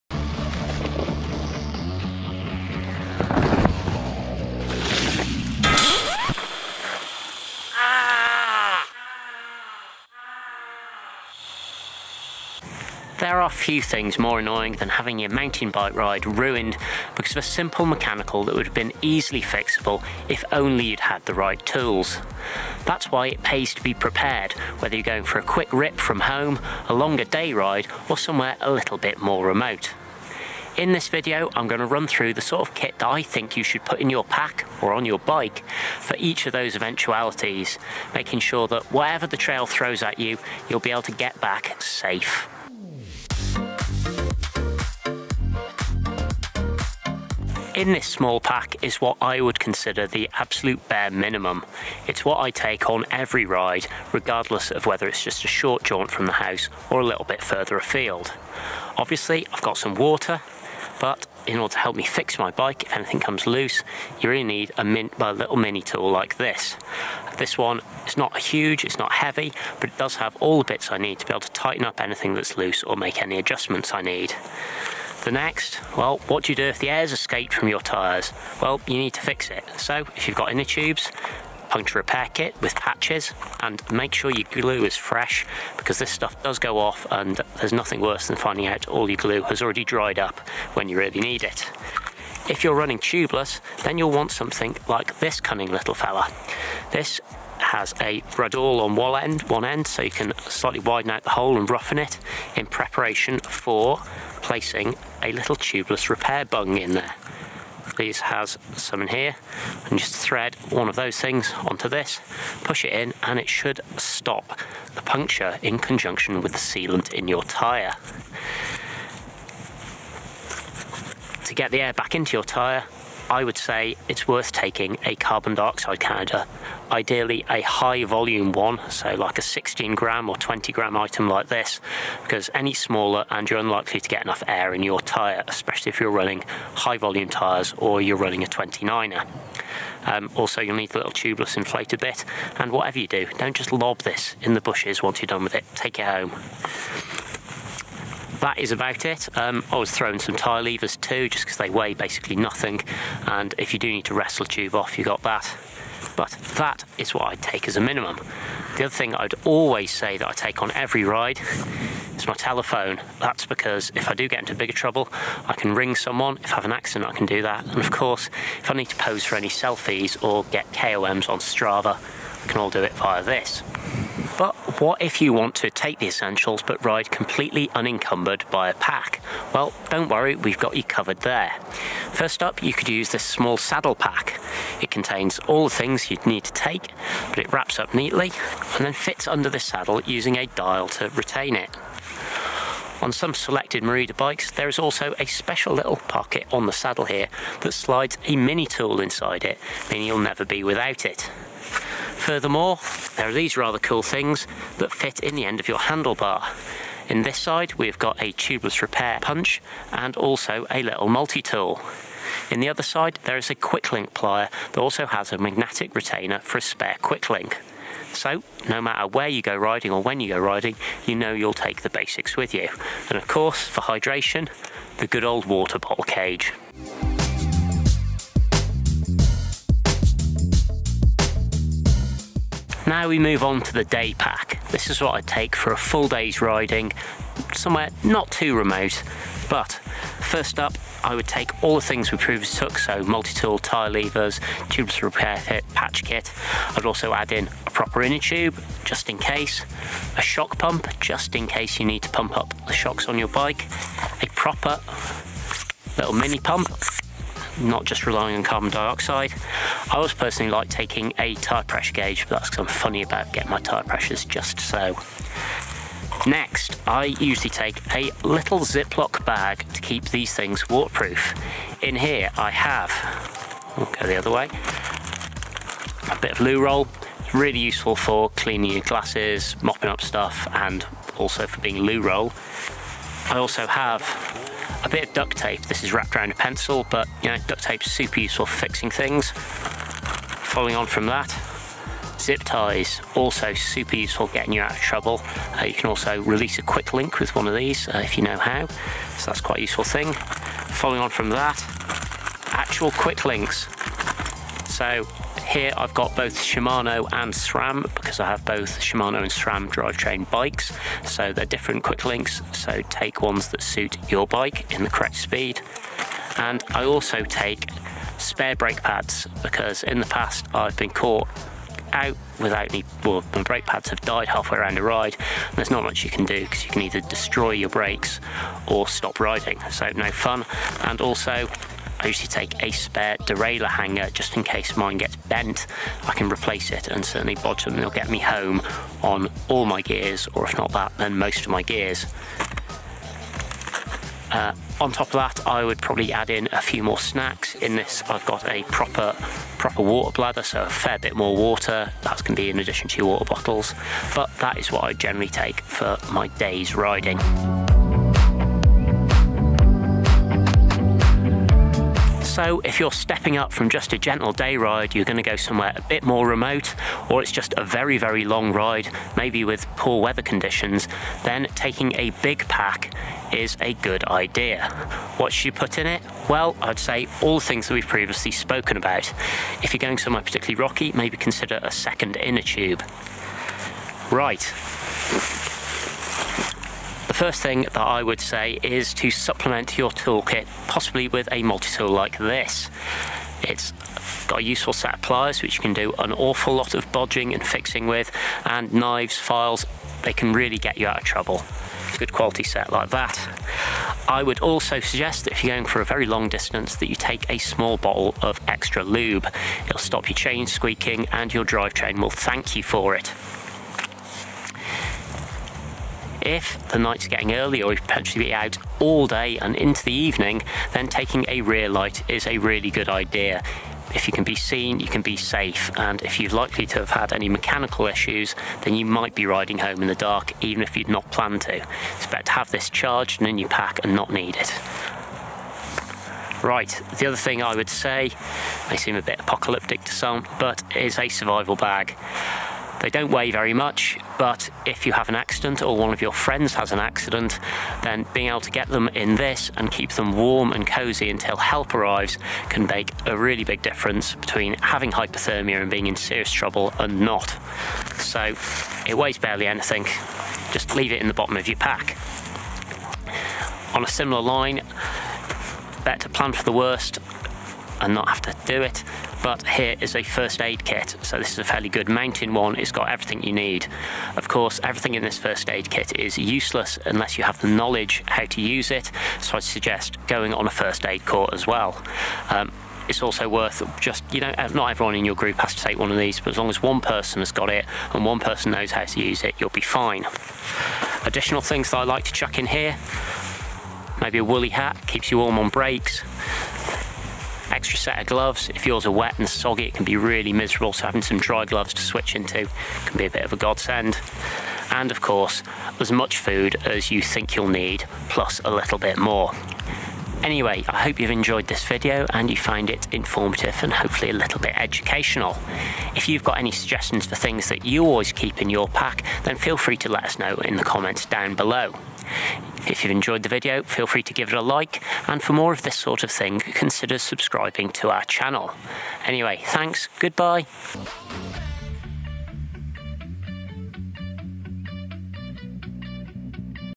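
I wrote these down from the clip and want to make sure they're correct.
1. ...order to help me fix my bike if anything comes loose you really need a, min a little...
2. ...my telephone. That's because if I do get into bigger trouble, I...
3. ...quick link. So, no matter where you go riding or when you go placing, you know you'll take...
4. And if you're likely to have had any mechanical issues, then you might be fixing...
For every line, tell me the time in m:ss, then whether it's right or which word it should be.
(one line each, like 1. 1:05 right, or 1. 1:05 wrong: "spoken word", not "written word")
1. 1:01 right
2. 2:42 right
3. 3:37 wrong: "riding", not "placing"
4. 7:05 wrong: "riding", not "fixing".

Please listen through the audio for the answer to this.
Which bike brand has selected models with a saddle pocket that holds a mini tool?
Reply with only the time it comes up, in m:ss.
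3:13.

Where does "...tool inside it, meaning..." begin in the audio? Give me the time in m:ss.
3:18.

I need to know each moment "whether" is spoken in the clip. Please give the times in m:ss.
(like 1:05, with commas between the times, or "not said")
0:24, 0:54.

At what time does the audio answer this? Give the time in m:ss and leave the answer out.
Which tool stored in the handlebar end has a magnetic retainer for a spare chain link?
3:33.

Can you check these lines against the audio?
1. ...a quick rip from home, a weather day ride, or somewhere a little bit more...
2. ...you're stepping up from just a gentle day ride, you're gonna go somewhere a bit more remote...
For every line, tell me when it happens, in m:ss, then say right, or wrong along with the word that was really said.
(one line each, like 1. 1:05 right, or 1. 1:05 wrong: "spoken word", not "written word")
1. 0:25 wrong: "longer", not "weather"
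2. 6:02 right.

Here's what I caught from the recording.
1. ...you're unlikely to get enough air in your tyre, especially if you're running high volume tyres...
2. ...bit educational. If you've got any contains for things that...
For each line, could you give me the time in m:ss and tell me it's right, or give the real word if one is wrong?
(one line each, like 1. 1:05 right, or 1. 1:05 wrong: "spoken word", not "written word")
1. 2:13 right
2. 8:34 wrong: "suggestions", not "contains".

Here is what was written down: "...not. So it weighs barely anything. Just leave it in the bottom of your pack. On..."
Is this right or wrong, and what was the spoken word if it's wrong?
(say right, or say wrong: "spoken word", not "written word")
right.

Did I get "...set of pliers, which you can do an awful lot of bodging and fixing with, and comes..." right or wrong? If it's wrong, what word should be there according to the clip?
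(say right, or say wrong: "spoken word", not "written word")
wrong: "knives", not "comes".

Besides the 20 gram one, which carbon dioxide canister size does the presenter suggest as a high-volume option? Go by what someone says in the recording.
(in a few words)
16 gram.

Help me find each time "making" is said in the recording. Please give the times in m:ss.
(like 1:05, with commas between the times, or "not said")
0:38.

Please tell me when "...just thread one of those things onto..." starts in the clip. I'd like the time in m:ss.
1:49.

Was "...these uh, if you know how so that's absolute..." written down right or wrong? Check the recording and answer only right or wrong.
wrong.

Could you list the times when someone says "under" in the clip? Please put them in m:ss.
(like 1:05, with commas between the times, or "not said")
3:09.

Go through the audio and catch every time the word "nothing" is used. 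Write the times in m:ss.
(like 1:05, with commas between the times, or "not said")
1:27, 2:32.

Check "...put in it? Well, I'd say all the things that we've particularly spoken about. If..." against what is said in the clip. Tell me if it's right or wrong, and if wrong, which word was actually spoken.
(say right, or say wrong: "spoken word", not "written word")
wrong: "previously", not "particularly".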